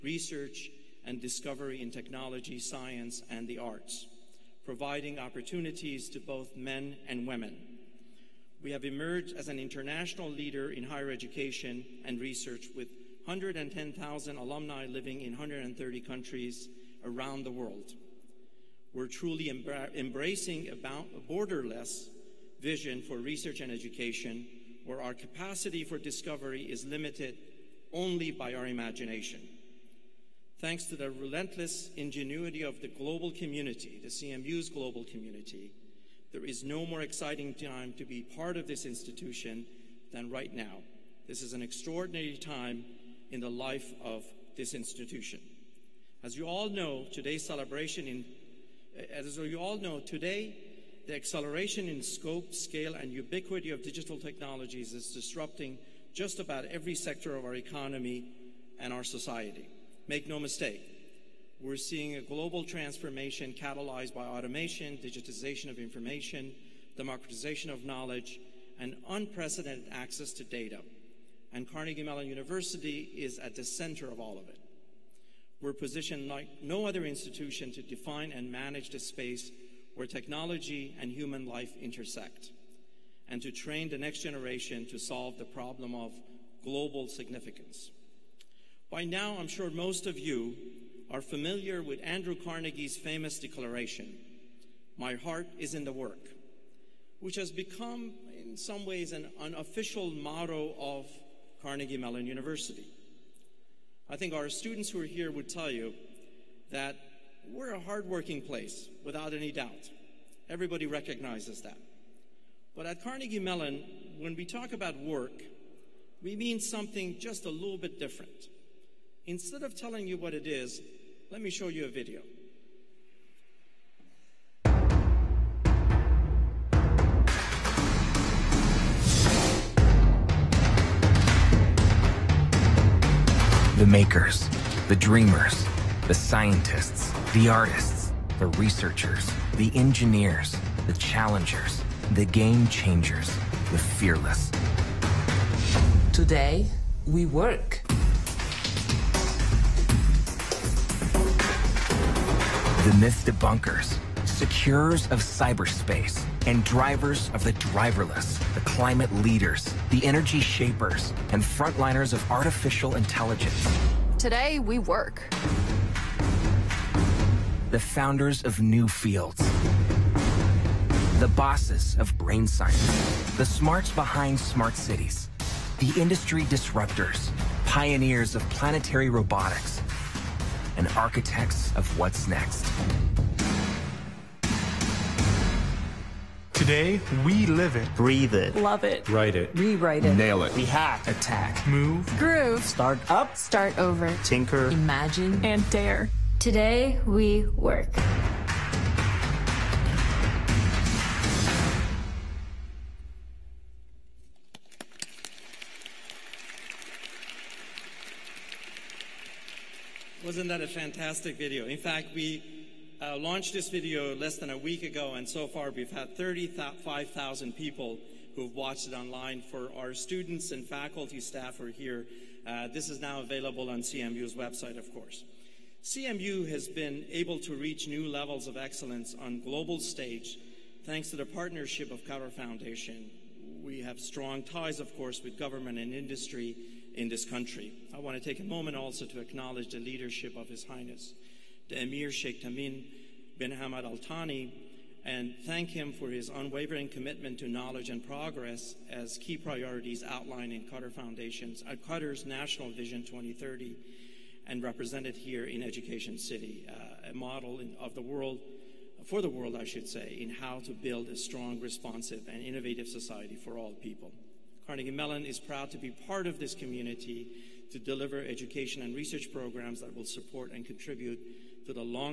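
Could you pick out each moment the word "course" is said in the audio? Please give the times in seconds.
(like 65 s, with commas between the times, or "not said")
224 s, 234 s.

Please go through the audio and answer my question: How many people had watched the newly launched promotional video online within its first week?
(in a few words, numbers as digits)
35,000.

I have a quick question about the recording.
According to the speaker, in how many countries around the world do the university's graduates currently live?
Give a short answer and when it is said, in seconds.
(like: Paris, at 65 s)
130, at 15 s.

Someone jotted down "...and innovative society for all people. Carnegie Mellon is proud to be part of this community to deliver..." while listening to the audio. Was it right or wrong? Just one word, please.
right.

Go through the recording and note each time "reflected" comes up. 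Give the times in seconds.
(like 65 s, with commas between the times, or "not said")
not said.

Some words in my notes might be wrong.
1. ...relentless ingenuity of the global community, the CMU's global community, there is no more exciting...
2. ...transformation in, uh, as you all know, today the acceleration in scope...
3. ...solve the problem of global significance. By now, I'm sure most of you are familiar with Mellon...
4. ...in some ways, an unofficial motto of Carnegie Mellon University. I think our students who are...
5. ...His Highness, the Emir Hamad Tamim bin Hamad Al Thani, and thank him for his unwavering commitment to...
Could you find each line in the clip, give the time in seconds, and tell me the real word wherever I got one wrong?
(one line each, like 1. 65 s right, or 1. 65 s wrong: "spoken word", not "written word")
1. 31 s right
2. 47 s wrong: "celebration", not "transformation"
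3. 84 s wrong: "Andrew", not "Mellon"
4. 98 s right
5. 240 s wrong: "Sheikh", not "Hamad".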